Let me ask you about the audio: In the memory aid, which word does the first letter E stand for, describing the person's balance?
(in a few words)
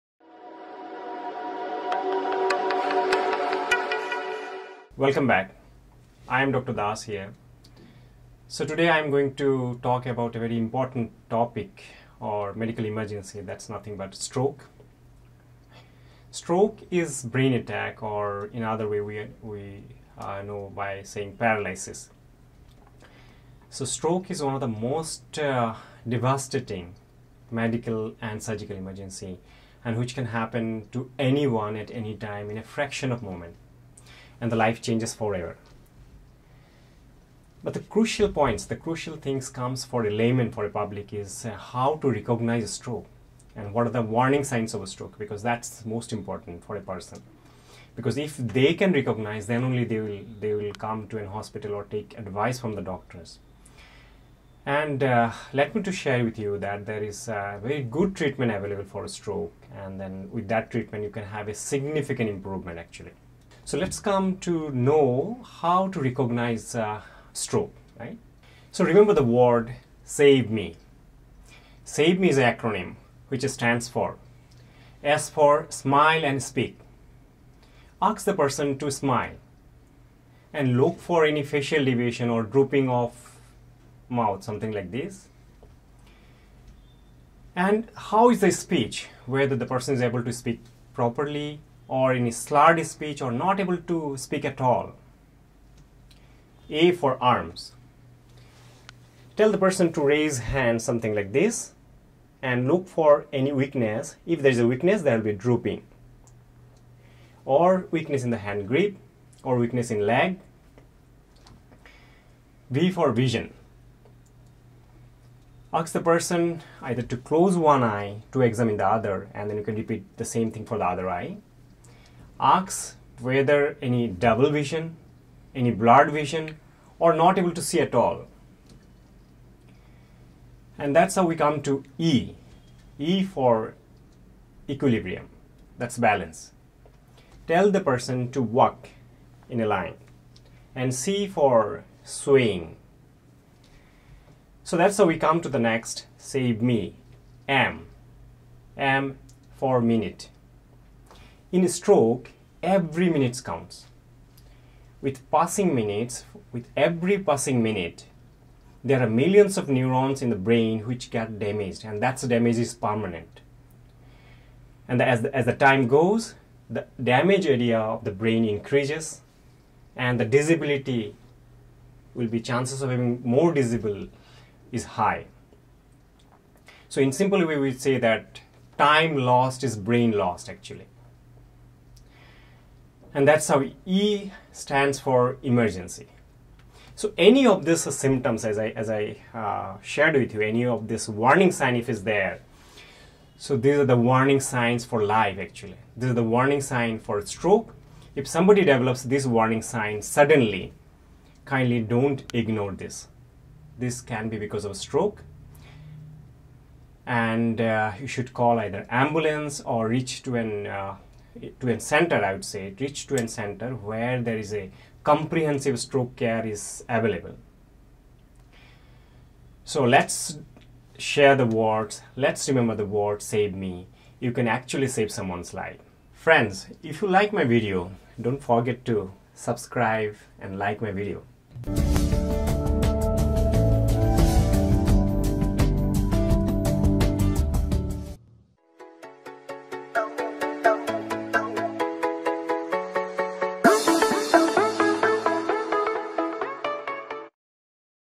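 equilibrium.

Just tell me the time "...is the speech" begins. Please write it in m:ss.
1:28.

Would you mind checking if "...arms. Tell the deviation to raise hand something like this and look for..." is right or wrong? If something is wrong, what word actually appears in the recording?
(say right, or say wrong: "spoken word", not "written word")
wrong: "person", not "deviation".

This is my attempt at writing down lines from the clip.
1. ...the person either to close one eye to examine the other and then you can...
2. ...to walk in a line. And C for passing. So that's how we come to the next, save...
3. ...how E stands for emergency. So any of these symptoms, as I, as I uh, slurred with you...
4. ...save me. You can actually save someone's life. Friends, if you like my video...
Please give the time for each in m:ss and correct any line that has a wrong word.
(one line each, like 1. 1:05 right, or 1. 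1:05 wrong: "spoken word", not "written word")
1. 1:55 right
2. 2:18 wrong: "swaying", not "passing"
3. 3:03 wrong: "shared", not "slurred"
4. 3:43 right.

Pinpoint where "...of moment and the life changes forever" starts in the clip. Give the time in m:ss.
0:33.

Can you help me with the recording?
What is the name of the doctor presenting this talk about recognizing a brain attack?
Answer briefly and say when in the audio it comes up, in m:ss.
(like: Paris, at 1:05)
Dr. Das, at 0:06.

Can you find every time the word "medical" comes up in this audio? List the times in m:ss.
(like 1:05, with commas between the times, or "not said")
0:12, 0:27.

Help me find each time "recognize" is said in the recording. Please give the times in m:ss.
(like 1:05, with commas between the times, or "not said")
0:42, 0:48, 1:06.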